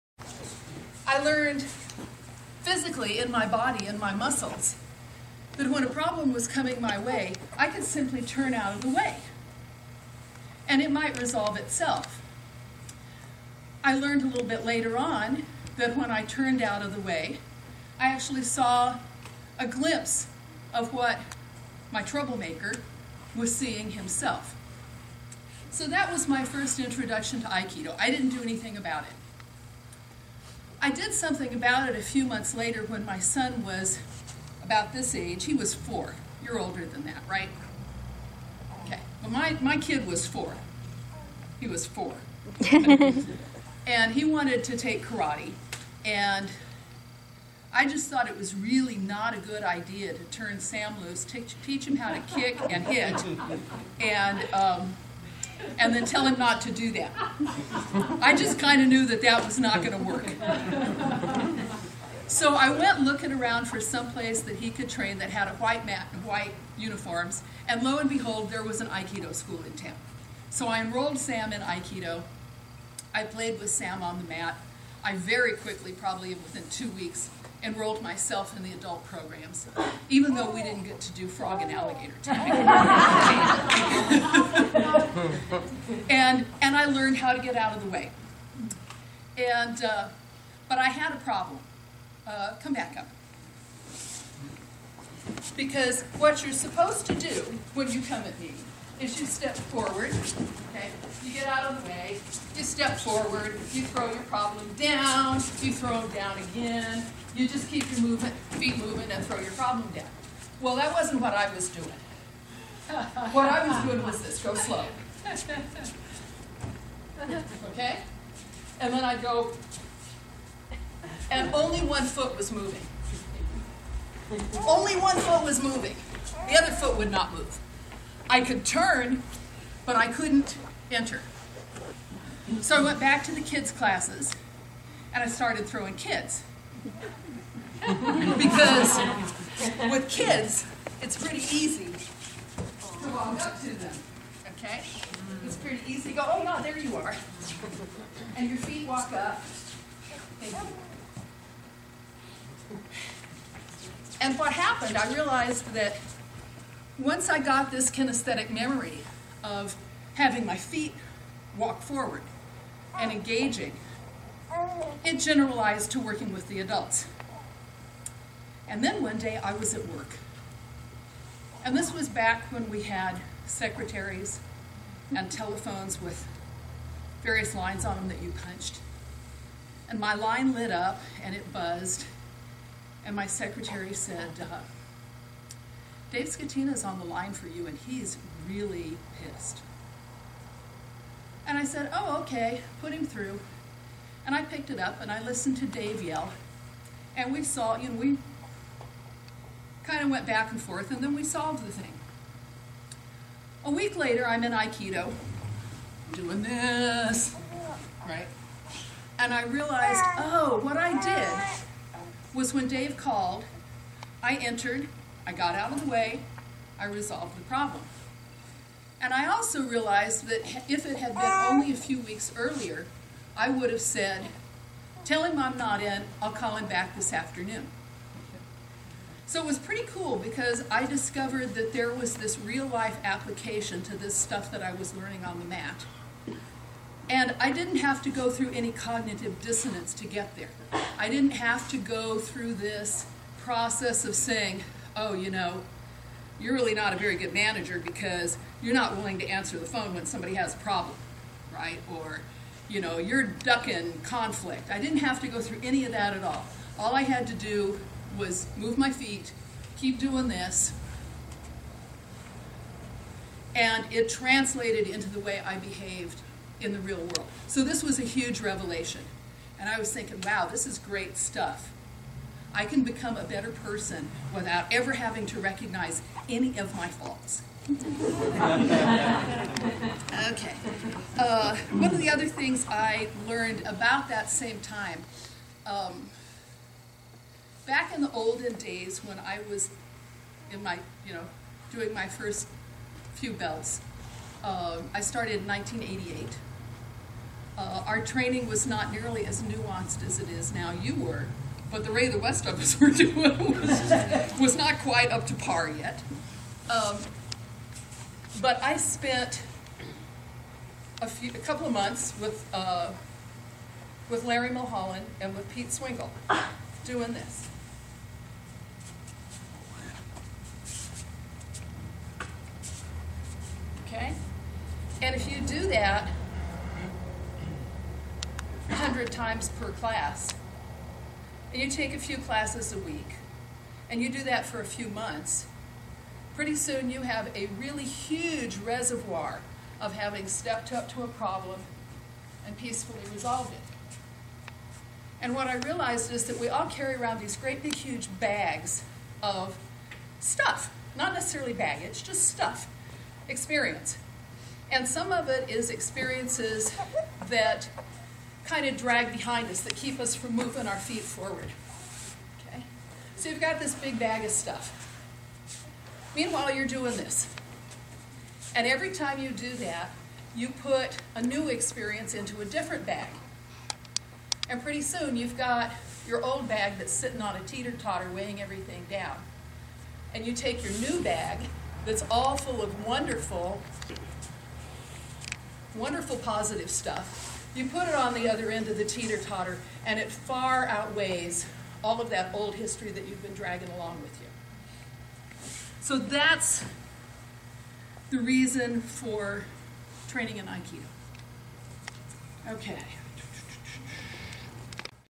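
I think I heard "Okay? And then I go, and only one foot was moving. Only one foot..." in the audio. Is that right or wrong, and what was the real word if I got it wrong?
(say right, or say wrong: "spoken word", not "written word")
right.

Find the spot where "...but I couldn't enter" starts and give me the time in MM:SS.
02:09.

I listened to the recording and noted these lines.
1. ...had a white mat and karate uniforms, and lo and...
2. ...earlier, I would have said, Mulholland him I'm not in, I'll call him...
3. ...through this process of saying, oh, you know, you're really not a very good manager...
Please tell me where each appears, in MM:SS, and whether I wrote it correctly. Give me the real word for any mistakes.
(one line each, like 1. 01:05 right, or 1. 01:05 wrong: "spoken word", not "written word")
1. 01:05 wrong: "white", not "karate"
2. 03:42 wrong: "Tell", not "Mulholland"
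3. 04:02 right.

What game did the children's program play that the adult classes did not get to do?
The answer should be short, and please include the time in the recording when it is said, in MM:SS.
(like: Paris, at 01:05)
Frog and alligator tag, at 01:21.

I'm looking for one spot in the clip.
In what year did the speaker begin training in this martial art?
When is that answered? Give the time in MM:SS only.
04:55.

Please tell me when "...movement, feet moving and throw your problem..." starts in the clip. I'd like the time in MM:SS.
01:48.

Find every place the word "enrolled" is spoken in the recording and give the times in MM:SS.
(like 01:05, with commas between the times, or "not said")
01:10, 01:17.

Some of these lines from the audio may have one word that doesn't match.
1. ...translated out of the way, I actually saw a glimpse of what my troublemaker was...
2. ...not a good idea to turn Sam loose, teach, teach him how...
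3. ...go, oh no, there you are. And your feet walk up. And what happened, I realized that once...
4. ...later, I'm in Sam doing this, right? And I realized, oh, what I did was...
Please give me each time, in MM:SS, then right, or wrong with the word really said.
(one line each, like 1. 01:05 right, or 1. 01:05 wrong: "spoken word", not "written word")
1. 00:16 wrong: "turned", not "translated"
2. 00:48 right
3. 02:26 right
4. 03:23 wrong: "Aikido", not "Sam".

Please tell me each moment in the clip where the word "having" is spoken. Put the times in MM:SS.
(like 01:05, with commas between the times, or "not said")
02:40, 04:34, 05:39.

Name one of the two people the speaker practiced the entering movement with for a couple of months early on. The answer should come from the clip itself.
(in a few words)
Larry Mulholland.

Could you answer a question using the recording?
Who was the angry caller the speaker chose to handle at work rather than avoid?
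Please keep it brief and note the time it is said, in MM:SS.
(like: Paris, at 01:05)
Dave Scatina, at 03:06.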